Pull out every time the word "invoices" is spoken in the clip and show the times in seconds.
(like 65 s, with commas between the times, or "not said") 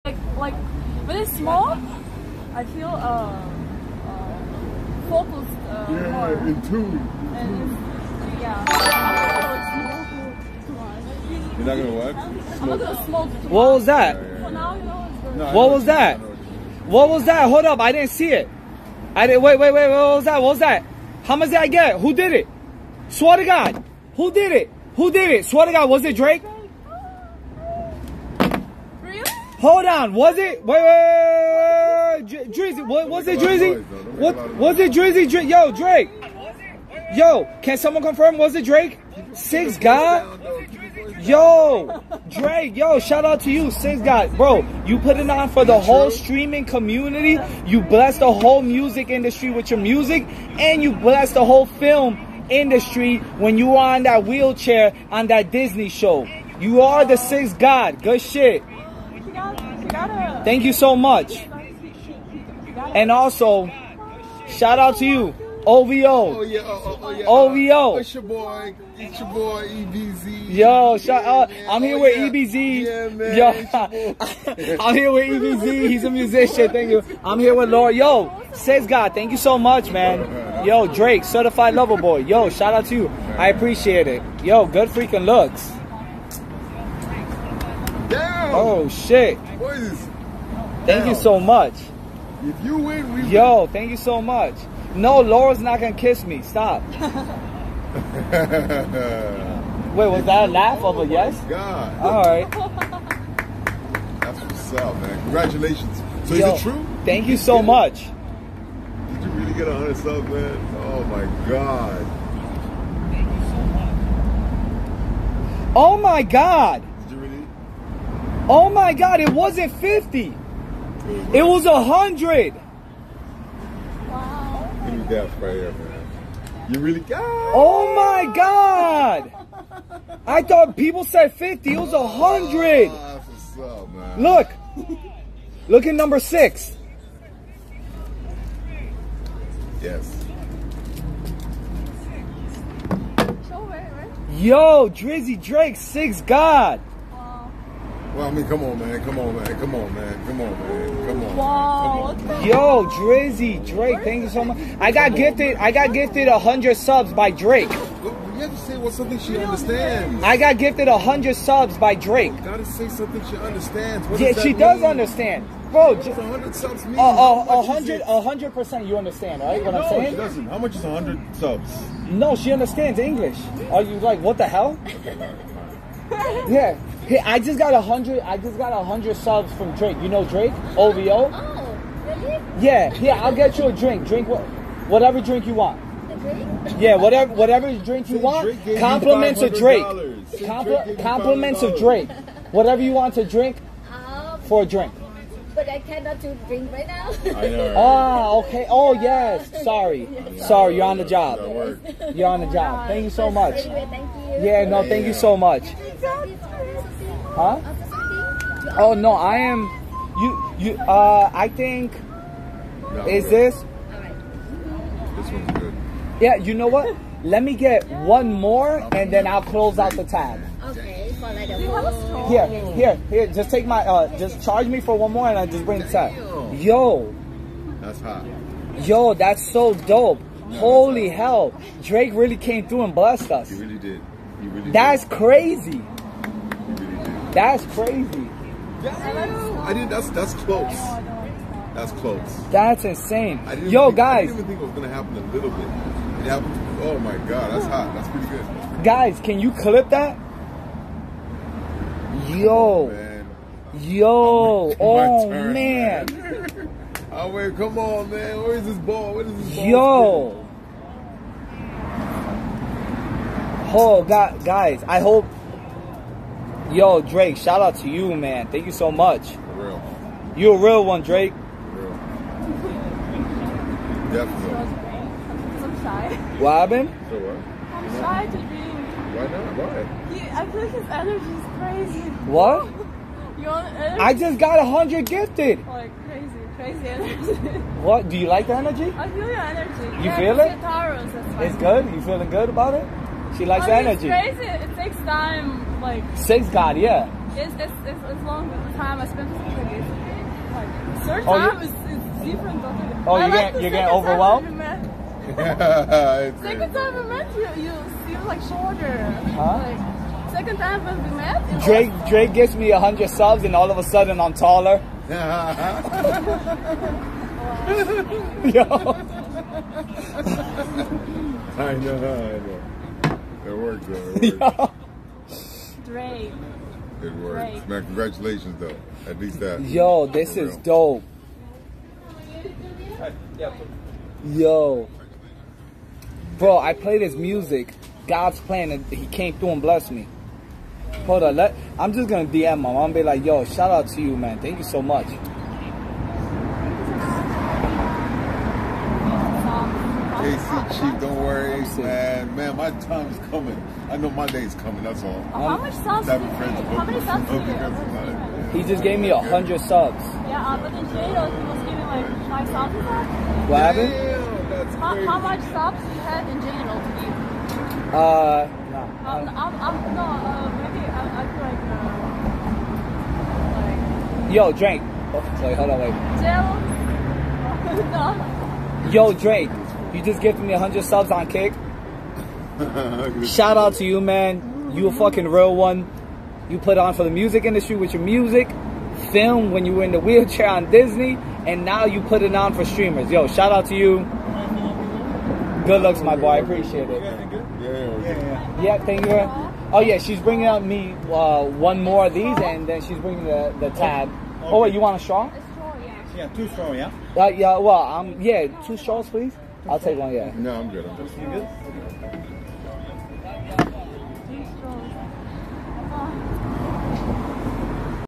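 not said.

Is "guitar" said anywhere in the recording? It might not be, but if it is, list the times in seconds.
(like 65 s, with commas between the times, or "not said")
not said.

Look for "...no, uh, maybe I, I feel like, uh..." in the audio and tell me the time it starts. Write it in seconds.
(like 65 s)
369 s.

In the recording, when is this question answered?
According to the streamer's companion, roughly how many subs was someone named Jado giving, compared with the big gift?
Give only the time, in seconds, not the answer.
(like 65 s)
362 s.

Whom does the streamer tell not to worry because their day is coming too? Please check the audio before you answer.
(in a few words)
AC Chief.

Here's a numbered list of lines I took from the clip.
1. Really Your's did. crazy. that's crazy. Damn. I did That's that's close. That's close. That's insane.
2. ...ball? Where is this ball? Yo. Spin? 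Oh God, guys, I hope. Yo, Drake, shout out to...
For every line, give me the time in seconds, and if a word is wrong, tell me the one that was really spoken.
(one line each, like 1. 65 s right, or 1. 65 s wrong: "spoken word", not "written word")
1. 234 s wrong: "That", not "Your"
2. 258 s right.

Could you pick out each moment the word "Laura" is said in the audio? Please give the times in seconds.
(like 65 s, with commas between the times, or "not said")
77 s, 95 s.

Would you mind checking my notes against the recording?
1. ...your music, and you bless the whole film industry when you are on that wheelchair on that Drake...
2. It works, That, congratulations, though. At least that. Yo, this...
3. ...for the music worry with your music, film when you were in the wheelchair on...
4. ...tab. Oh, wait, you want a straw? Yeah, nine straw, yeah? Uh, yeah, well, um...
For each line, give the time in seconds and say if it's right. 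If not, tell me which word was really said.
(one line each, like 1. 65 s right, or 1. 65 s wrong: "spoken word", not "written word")
1. 49 s wrong: "Disney", not "Drake"
2. 327 s wrong: "Man", not "That"
3. 386 s wrong: "industry", not "worry"
4. 403 s wrong: "two", not "nine".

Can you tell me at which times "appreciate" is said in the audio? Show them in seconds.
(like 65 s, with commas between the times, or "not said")
83 s, 396 s.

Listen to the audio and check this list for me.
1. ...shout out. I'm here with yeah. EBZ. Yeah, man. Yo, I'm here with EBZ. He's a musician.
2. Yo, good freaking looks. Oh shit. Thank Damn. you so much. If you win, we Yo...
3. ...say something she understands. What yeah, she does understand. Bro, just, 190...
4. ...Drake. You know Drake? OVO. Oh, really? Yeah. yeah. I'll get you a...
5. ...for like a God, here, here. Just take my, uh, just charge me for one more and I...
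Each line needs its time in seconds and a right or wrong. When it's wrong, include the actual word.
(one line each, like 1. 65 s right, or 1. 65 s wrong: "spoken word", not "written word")
1. 70 s right
2. 84 s right
3. 162 s wrong: "100", not "190"
4. 179 s right
5. 221 s wrong: "Here", not "God".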